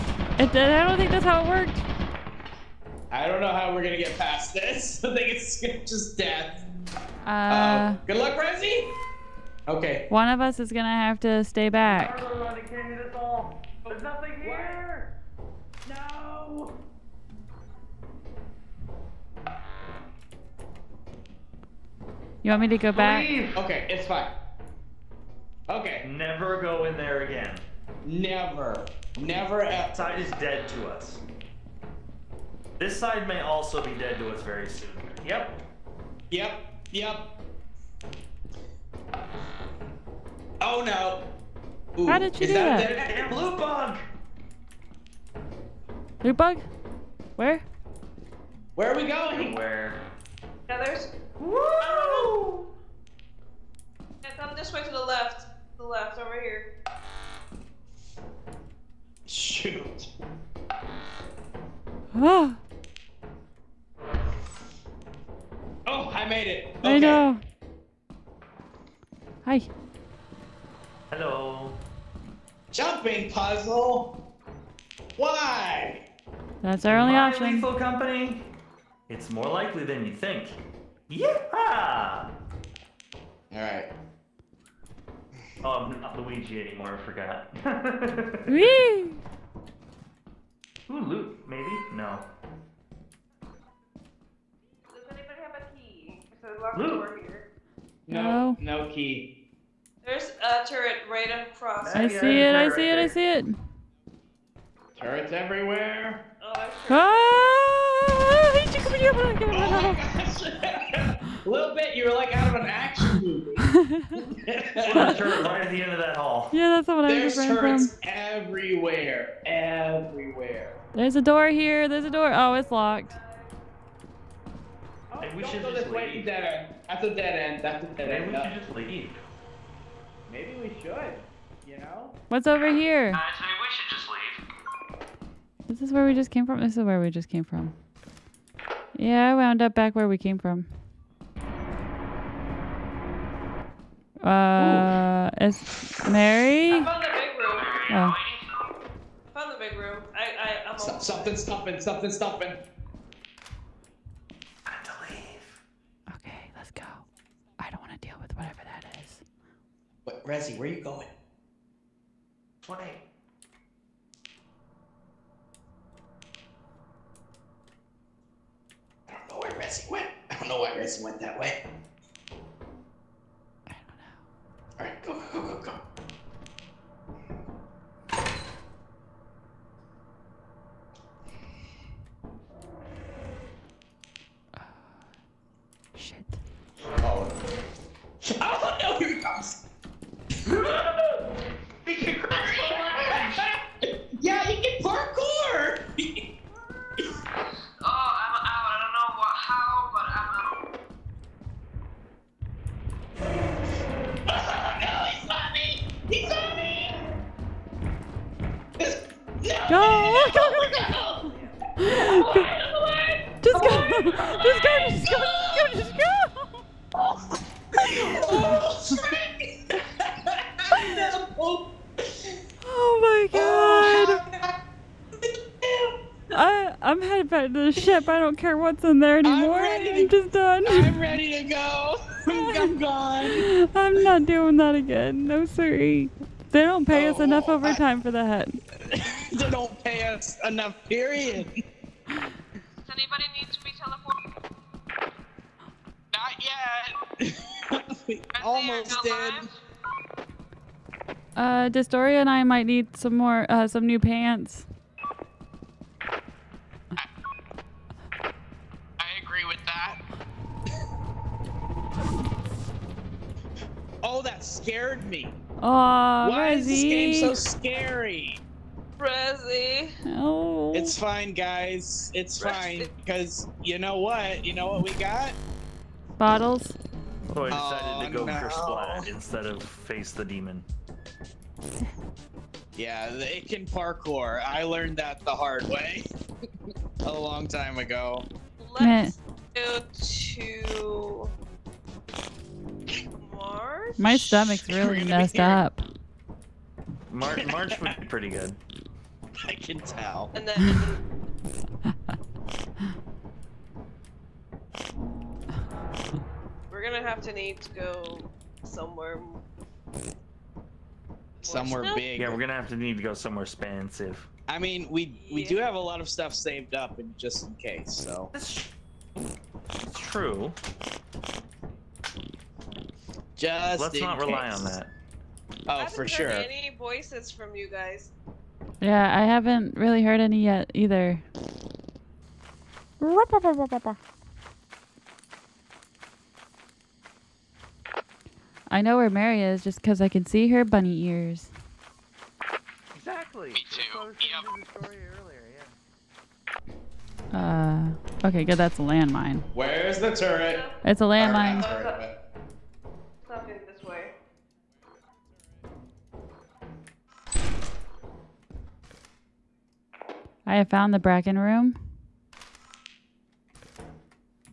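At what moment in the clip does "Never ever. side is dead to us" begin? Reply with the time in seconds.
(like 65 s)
29 s.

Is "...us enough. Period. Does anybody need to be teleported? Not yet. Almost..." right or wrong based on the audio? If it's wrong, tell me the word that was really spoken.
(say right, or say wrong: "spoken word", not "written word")
right.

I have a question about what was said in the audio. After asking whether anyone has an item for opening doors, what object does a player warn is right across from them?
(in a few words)
A turret.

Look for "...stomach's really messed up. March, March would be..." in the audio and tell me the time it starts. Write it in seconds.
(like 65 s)
294 s.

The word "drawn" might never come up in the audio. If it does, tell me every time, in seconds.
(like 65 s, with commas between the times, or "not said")
not said.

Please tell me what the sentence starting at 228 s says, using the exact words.
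I don't care what's in there anymore.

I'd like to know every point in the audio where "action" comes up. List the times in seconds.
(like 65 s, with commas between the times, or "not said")
112 s.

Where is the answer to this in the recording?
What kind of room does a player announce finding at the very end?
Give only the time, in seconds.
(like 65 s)
360 s.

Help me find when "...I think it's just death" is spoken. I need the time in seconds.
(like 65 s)
5 s.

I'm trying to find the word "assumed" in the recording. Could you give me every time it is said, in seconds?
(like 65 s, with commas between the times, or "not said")
not said.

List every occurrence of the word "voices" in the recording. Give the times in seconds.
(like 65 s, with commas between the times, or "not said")
326 s.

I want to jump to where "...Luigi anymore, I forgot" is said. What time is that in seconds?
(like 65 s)
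86 s.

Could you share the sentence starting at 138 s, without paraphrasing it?
Yeah, I wound up back where we came from.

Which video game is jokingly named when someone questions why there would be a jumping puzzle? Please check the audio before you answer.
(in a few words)
Lethal Company.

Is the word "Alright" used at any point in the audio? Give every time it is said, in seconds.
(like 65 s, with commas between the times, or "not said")
83 s, 174 s.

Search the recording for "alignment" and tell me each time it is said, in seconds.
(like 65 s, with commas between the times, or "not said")
not said.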